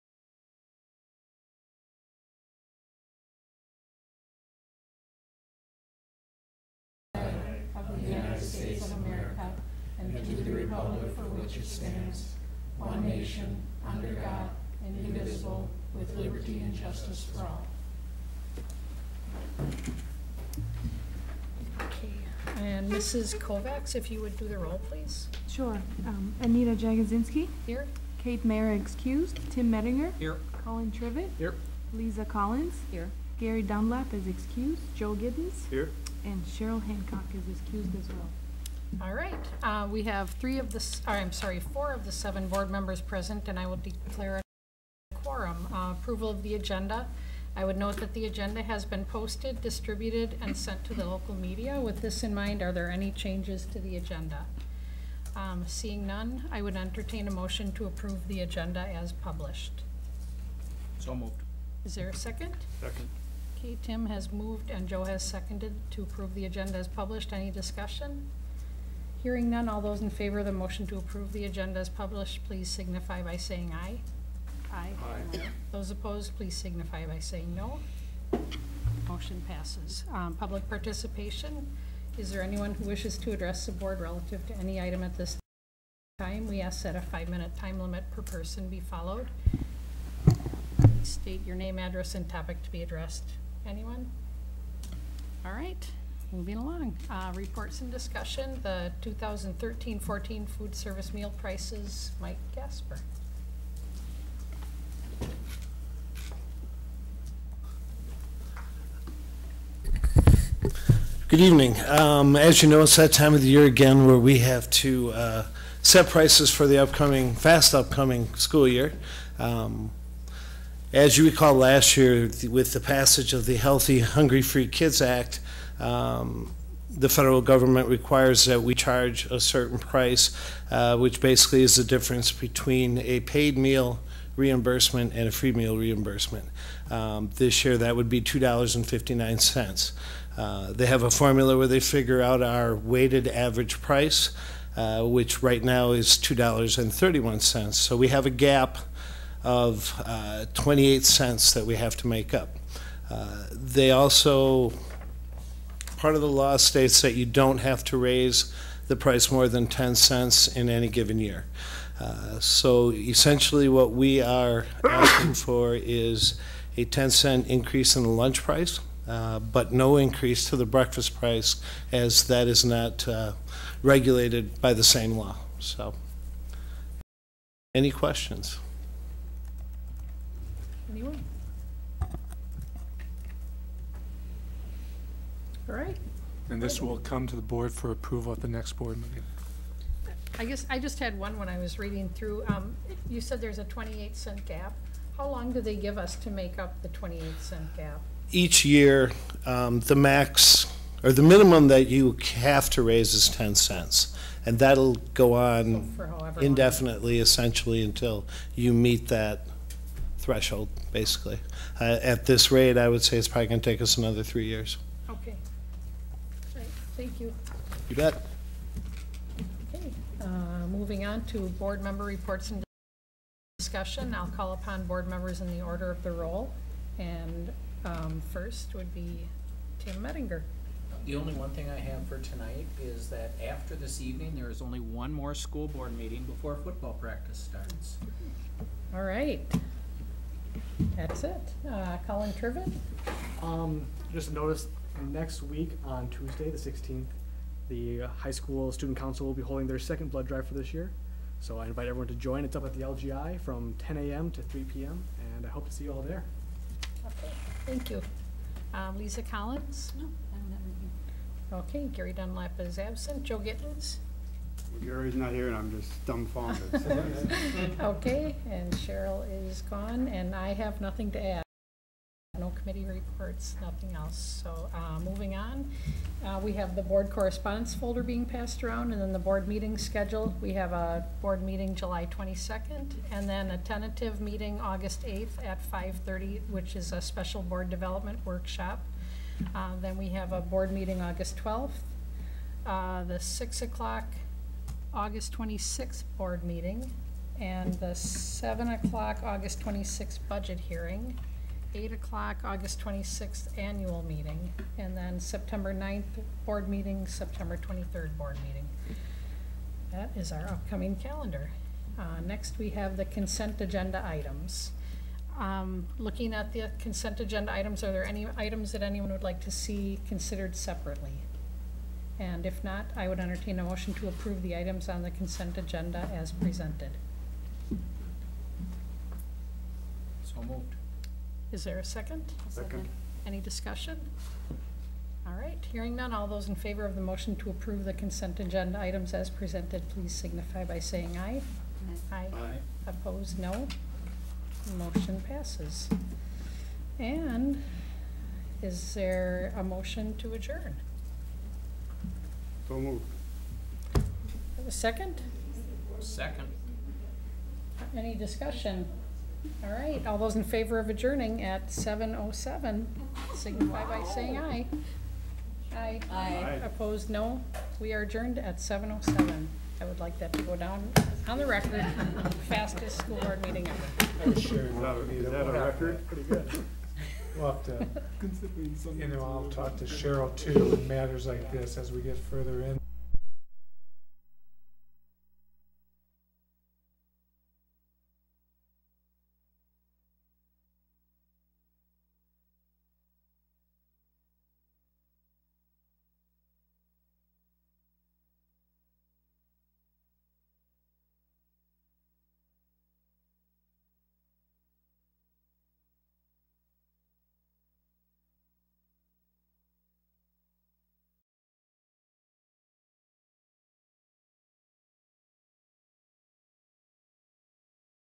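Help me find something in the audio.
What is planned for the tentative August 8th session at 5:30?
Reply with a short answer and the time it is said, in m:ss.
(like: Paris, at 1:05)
Board development workshop, at 4:47.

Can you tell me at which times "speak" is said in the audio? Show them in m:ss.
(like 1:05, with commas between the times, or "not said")
not said.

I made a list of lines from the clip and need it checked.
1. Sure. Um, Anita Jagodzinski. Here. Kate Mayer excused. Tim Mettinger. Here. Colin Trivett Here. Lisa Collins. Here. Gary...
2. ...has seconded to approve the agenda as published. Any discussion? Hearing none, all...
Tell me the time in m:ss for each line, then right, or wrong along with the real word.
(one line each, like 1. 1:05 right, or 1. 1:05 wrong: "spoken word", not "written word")
1. 0:25 right
2. 1:05 right.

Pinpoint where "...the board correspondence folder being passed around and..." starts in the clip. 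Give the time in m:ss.
4:36.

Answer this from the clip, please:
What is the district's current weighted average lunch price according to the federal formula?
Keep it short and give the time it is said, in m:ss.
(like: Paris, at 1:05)
$2.31, at 2:26.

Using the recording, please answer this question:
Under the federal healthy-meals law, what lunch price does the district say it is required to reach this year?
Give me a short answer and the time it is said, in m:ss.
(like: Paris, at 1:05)
$2.59, at 2:18.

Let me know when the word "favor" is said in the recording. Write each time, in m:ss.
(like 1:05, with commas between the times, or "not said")
1:10, 5:36, 6:00.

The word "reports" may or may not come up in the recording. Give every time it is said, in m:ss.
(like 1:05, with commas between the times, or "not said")
1:37, 3:42, 4:32.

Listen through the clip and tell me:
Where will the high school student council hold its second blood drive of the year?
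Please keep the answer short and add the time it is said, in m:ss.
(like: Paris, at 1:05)
The LGI, at 4:12.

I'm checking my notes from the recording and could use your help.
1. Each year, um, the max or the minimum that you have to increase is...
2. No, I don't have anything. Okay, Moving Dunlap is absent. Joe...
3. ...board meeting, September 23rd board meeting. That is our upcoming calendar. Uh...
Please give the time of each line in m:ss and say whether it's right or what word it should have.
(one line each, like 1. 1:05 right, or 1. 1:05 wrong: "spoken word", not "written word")
1. 3:18 wrong: "raise", not "increase"
2. 4:19 wrong: "Gary", not "Moving"
3. 5:06 right.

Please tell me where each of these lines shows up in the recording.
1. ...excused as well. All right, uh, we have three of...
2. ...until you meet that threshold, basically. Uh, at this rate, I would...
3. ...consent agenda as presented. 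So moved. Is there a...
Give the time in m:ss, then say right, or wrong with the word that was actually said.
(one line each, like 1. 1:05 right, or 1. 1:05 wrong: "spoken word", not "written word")
1. 0:37 right
2. 3:27 right
3. 5:25 right.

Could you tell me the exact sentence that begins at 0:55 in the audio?
Um, seeing none, I would entertain a motion to approve the agenda as published.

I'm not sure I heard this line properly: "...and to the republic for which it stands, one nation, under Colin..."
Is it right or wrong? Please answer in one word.
wrong.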